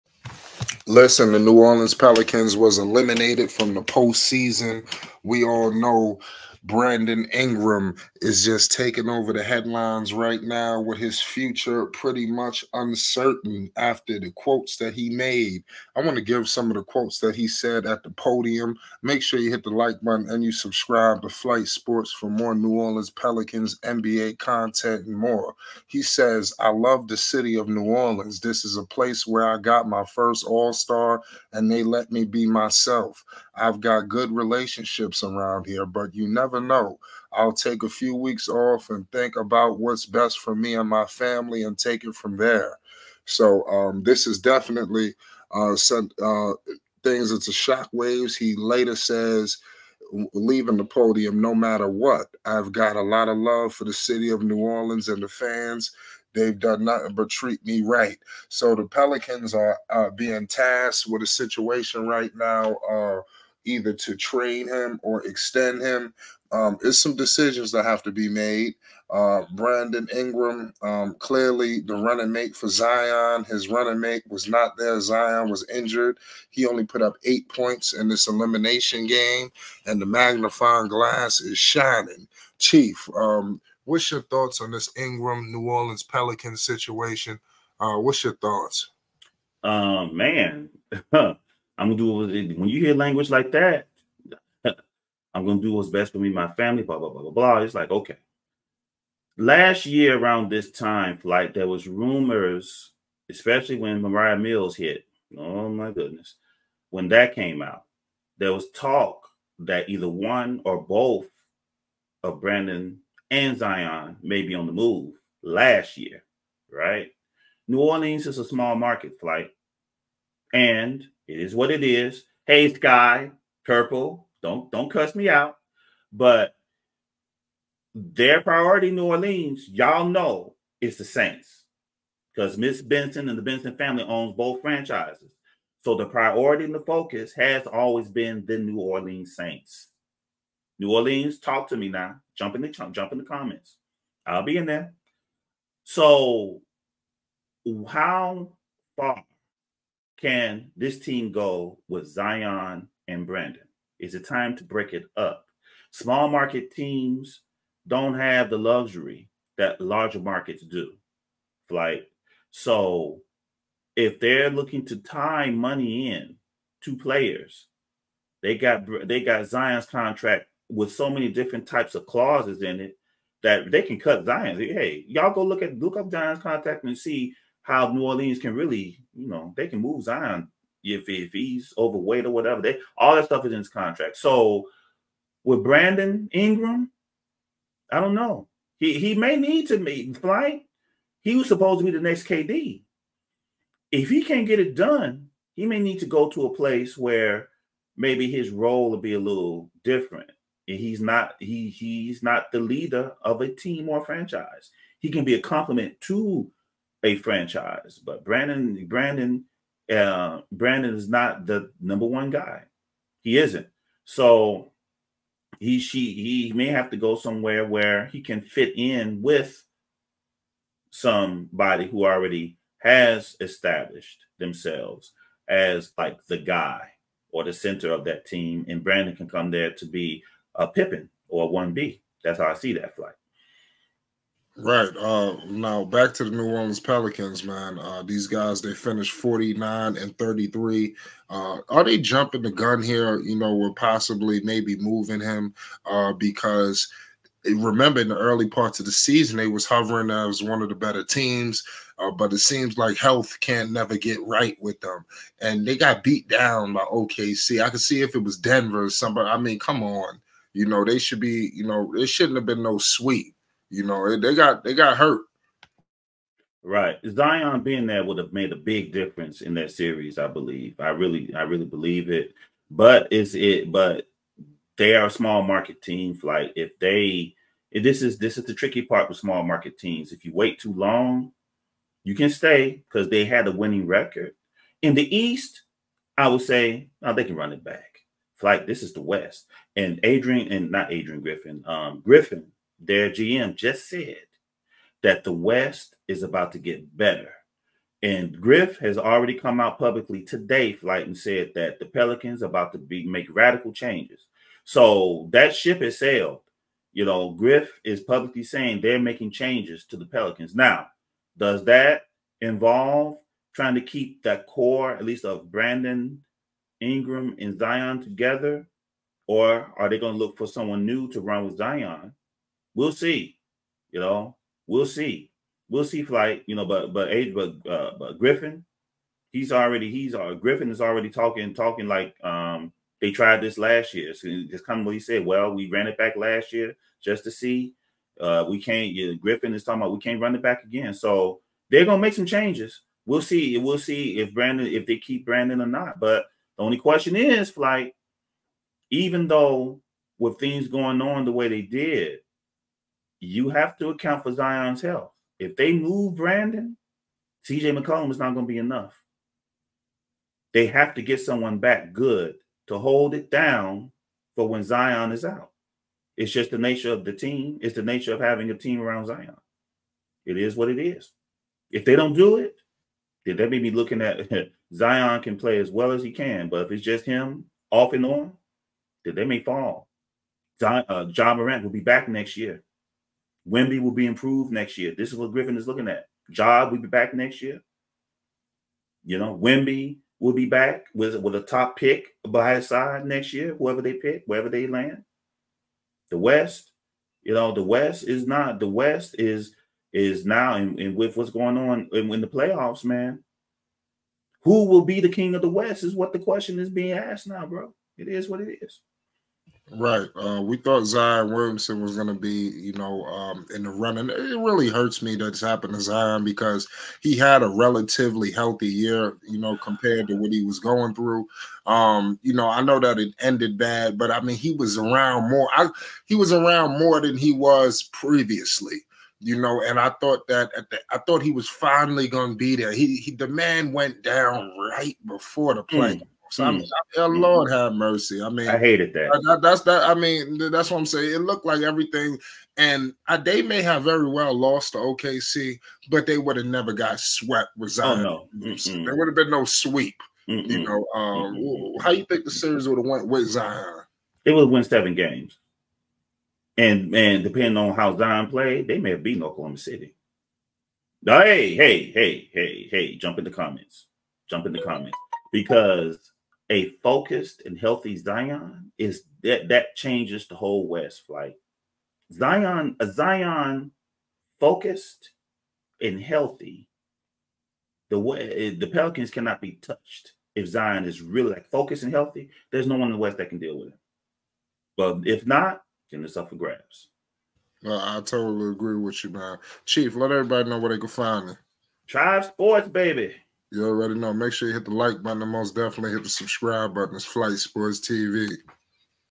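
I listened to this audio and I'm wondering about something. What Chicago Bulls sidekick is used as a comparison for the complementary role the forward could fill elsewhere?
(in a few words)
Pippin.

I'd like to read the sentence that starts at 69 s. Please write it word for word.
Uh, Brandon Ingram, um, clearly the running mate for Zion.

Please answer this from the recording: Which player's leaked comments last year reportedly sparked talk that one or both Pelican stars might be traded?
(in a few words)
Mariah Mills.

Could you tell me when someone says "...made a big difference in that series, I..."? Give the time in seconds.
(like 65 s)
268 s.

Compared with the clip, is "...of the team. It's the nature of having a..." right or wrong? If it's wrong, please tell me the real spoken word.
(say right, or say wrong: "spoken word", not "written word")
right.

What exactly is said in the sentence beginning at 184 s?
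So with Brandon Ingram, I don't know.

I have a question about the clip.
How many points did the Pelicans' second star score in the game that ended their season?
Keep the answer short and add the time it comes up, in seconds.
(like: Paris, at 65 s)
8, at 77 s.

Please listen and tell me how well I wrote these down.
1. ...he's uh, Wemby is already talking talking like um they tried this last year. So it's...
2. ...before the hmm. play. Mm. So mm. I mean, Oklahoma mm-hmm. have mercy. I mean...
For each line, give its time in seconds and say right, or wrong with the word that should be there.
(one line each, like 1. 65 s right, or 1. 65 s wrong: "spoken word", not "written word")
1. 329 s wrong: "Griffin", not "Wemby"
2. 435 s wrong: "Lord", not "Oklahoma".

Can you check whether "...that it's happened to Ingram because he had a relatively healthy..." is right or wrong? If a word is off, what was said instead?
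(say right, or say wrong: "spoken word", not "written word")
wrong: "Zion", not "Ingram".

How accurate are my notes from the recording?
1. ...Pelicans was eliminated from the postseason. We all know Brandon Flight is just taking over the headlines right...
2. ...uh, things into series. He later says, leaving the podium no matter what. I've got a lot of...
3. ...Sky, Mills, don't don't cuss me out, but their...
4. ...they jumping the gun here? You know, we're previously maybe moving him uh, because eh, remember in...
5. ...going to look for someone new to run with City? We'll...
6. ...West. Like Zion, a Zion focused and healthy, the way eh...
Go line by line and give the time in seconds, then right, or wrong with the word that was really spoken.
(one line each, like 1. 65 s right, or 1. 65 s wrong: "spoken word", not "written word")
1. 1 s wrong: "Ingram", not "Flight"
2. 46 s wrong: "shockwaves", not "series"
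3. 122 s wrong: "Purple", not "Mills"
4. 241 s wrong: "possibly", not "previously"
5. 319 s wrong: "Zion", not "City"
6. 470 s right.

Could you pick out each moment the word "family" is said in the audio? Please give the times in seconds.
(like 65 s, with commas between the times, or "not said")
41 s, 96 s, 133 s.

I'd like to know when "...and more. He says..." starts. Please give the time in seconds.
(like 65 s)
25 s.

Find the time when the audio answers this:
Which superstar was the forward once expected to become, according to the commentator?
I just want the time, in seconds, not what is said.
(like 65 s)
192 s.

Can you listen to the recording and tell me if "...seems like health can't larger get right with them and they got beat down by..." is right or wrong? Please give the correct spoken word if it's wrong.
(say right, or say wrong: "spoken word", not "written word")
wrong: "never", not "larger".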